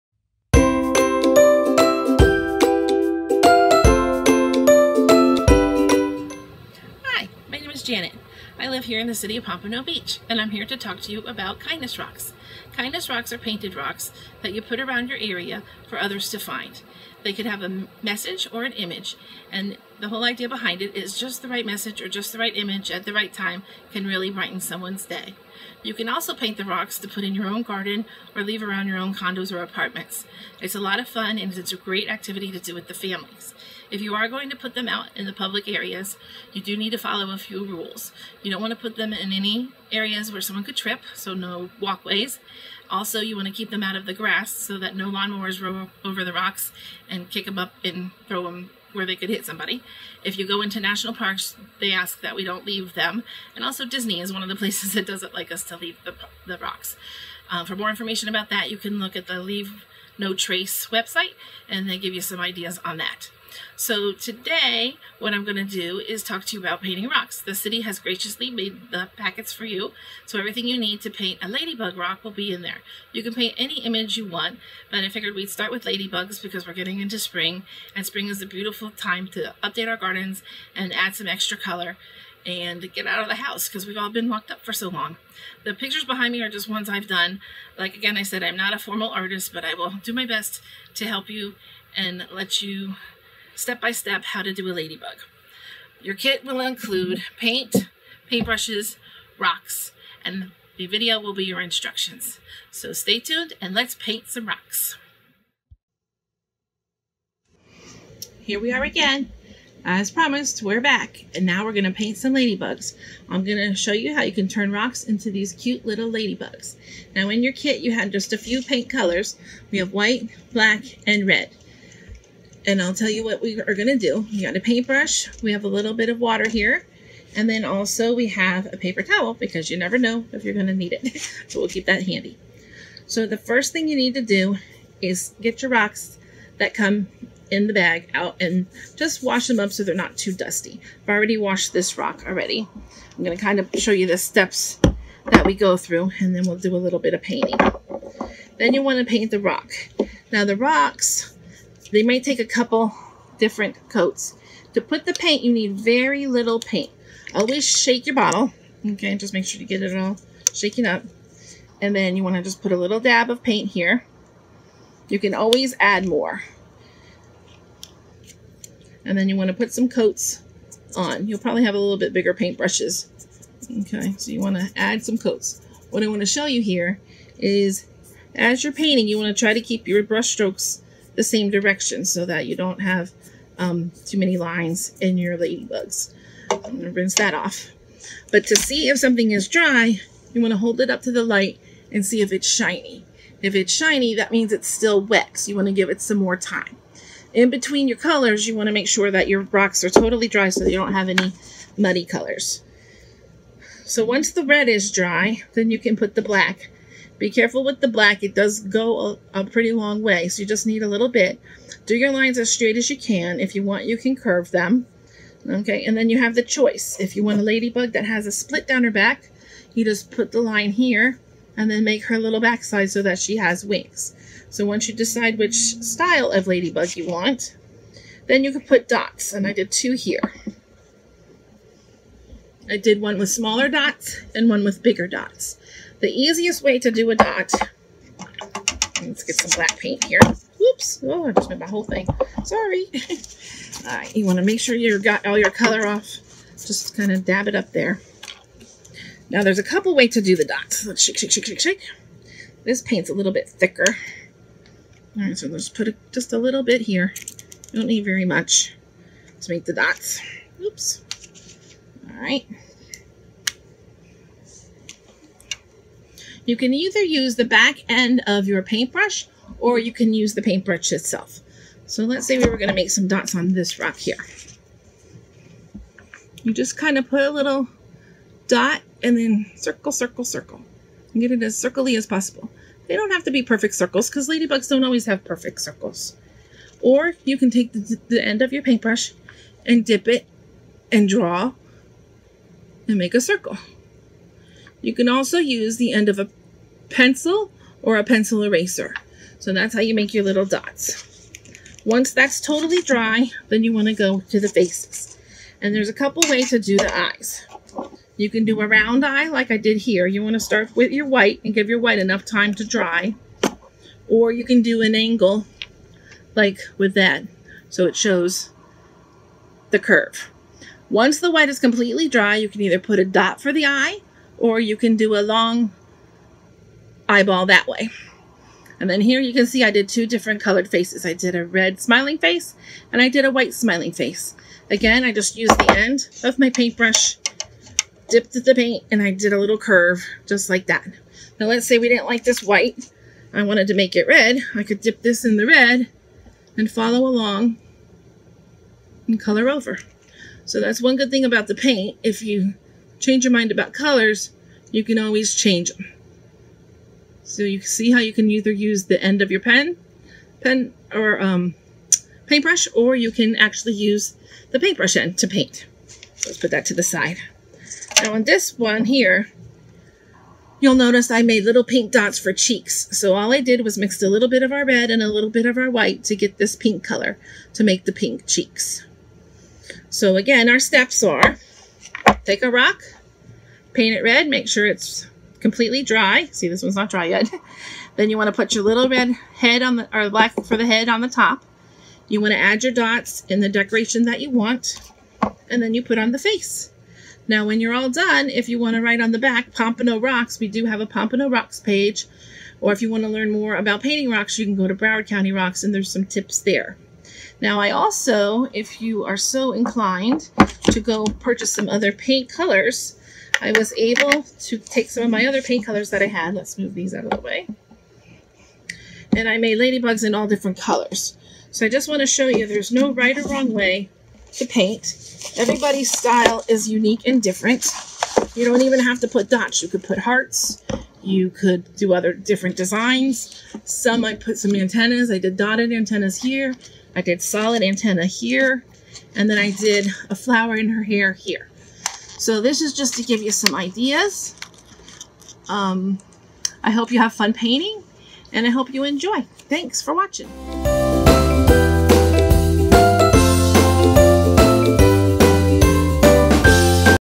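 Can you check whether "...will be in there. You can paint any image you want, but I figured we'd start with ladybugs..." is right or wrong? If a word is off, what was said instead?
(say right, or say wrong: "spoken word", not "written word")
right.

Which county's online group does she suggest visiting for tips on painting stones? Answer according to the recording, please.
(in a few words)
Broward County.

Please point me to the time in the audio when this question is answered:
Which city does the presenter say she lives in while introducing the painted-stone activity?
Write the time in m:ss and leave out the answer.
0:09.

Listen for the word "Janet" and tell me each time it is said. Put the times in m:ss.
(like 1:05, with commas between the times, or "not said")
0:07.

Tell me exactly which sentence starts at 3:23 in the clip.
So once the red is dry, then you can put the black be careful with the black.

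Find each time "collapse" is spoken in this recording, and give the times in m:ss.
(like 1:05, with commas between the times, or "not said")
not said.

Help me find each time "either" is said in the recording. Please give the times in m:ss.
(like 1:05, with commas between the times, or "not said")
4:26, 5:22, 5:58.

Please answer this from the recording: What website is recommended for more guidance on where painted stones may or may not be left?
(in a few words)
Leave No Trace.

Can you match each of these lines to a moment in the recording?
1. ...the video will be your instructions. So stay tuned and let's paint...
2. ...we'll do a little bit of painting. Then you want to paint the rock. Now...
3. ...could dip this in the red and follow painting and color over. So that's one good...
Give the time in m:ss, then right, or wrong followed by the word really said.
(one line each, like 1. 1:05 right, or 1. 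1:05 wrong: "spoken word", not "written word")
1. 1:40 right
2. 2:26 right
3. 5:44 wrong: "along", not "painting".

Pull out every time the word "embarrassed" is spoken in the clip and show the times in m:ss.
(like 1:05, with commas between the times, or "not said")
not said.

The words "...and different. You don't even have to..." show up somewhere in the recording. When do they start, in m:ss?
7:07.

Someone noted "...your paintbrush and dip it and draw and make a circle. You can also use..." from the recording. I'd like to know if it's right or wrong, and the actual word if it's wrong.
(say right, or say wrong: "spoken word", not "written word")
right.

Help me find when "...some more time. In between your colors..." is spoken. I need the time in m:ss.
3:16.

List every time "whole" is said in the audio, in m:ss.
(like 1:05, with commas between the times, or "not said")
0:20, 4:01.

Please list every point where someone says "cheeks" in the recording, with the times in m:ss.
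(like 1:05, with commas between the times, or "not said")
6:12, 6:18.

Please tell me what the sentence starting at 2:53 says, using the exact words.
Okay, so you want to add some coats.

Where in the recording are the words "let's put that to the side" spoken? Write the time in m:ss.
6:06.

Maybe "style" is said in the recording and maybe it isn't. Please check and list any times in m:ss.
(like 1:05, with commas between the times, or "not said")
3:45, 7:05.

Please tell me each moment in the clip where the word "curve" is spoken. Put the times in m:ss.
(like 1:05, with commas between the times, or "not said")
3:34, 5:19, 5:39.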